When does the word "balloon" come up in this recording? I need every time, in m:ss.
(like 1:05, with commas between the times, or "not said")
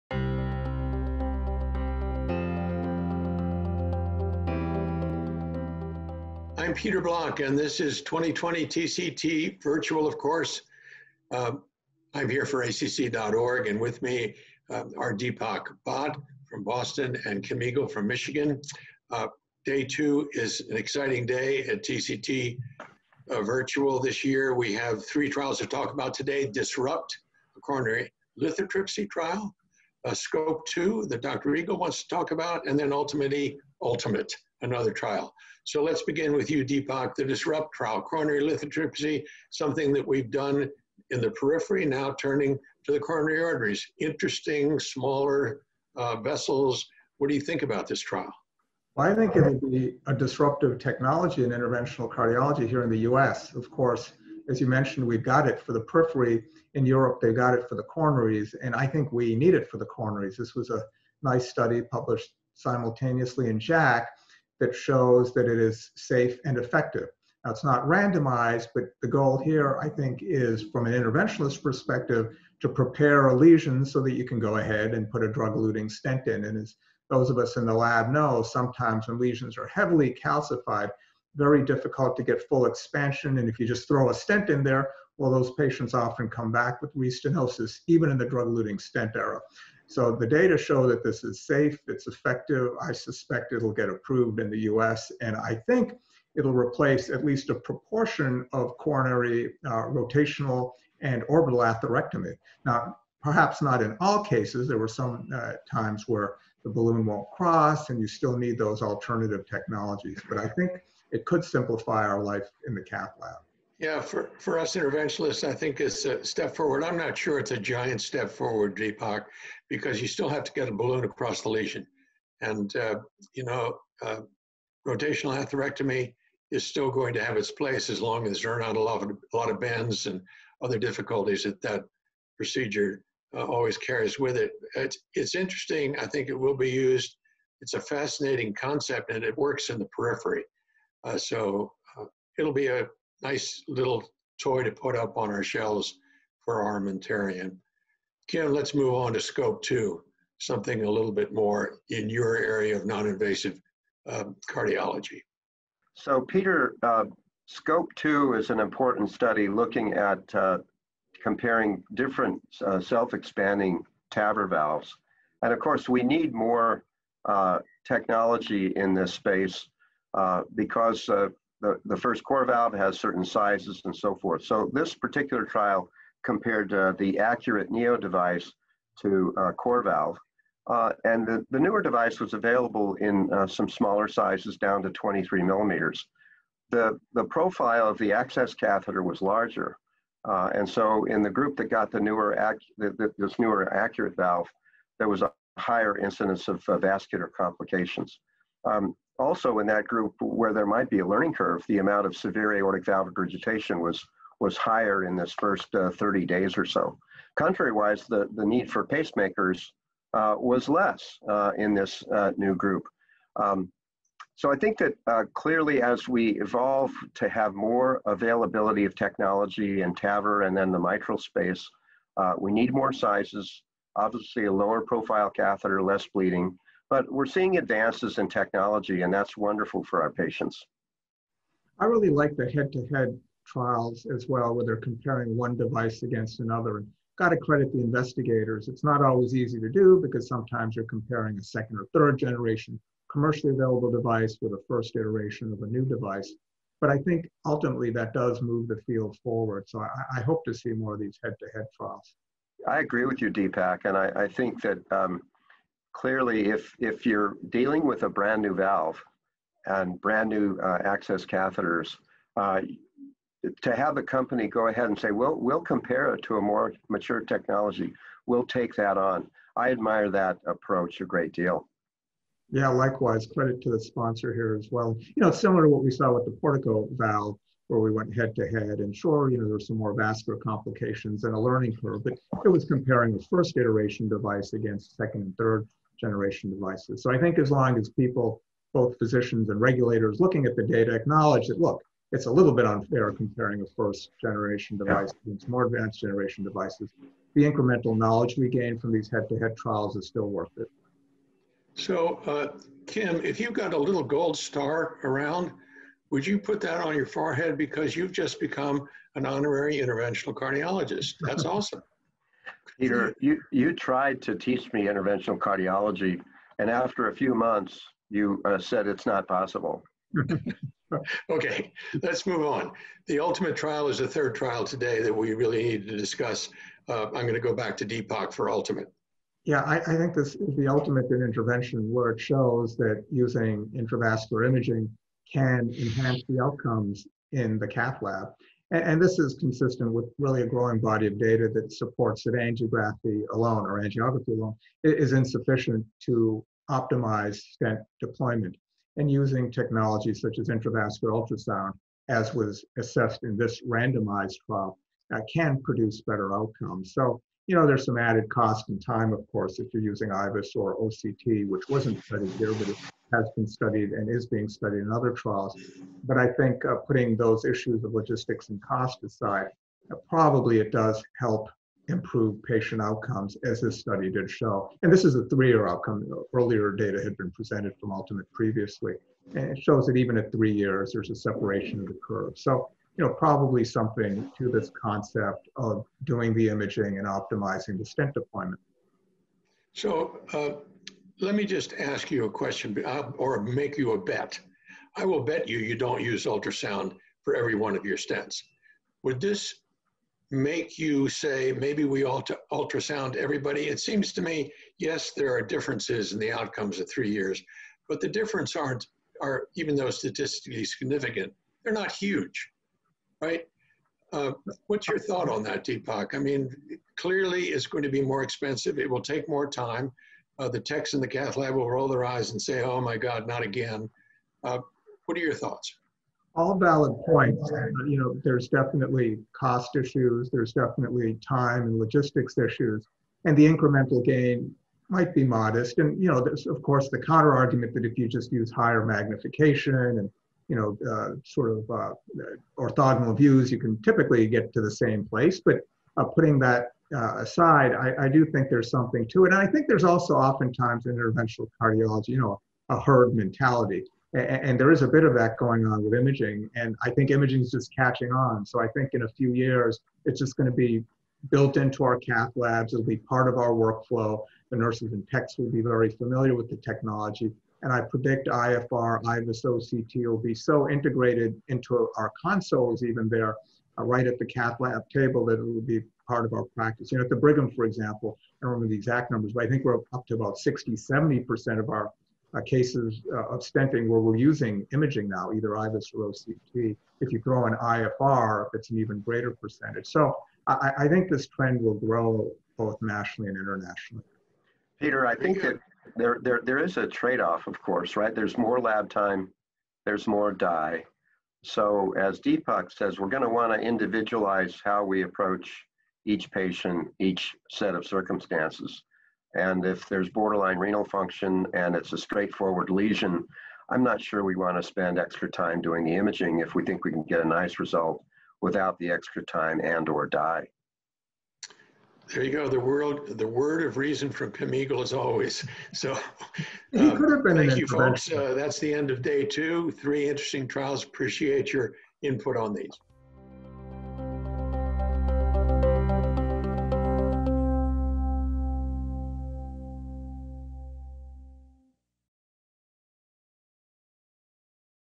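1:46, 2:00.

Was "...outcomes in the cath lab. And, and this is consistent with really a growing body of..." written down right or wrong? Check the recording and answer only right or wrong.
right.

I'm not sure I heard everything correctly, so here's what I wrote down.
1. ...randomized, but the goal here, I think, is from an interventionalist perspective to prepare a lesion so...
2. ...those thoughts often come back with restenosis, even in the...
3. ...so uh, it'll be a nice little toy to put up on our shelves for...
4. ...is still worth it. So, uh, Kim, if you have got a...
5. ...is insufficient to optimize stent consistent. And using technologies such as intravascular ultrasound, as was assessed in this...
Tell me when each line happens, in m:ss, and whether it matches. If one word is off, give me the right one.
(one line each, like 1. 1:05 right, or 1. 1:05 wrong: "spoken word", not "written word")
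1. 1:07 right
2. 1:25 wrong: "patients", not "thoughts"
3. 2:21 right
4. 4:59 right
5. 5:44 wrong: "deployment", not "consistent".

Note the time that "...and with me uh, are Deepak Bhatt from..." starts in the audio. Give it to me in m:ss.
0:13.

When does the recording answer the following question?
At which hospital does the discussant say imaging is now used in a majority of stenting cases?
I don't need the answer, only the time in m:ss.
7:57.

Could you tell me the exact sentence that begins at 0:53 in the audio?
Of course, as you mentioned, we've got it for the periphery.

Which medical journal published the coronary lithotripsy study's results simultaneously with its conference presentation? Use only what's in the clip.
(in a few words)
JACC.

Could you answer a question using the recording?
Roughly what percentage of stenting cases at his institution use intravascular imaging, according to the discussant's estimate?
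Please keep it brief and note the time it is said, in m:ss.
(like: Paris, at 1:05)
60-70%, at 8:00.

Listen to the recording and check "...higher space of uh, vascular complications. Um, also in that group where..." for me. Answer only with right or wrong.
wrong.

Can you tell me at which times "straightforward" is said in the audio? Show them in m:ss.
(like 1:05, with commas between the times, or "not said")
8:31.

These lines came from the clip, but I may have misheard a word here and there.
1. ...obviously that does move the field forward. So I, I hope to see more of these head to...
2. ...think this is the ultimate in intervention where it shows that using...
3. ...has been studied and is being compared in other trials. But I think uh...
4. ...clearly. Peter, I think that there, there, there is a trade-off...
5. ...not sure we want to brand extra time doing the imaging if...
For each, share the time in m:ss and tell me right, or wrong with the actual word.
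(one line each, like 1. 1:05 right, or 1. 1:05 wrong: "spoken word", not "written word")
1. 4:07 wrong: "ultimately", not "obviously"
2. 5:29 right
3. 6:03 wrong: "studied", not "compared"
4. 8:13 wrong: "internationally", not "clearly"
5. 8:33 wrong: "spend", not "brand".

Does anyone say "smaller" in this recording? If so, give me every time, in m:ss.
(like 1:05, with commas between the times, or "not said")
0:44, 3:03.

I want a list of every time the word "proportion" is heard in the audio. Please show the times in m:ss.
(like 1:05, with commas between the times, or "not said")
1:37.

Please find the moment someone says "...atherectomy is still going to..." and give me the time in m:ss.
2:05.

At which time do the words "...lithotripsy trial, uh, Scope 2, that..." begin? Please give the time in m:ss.
0:28.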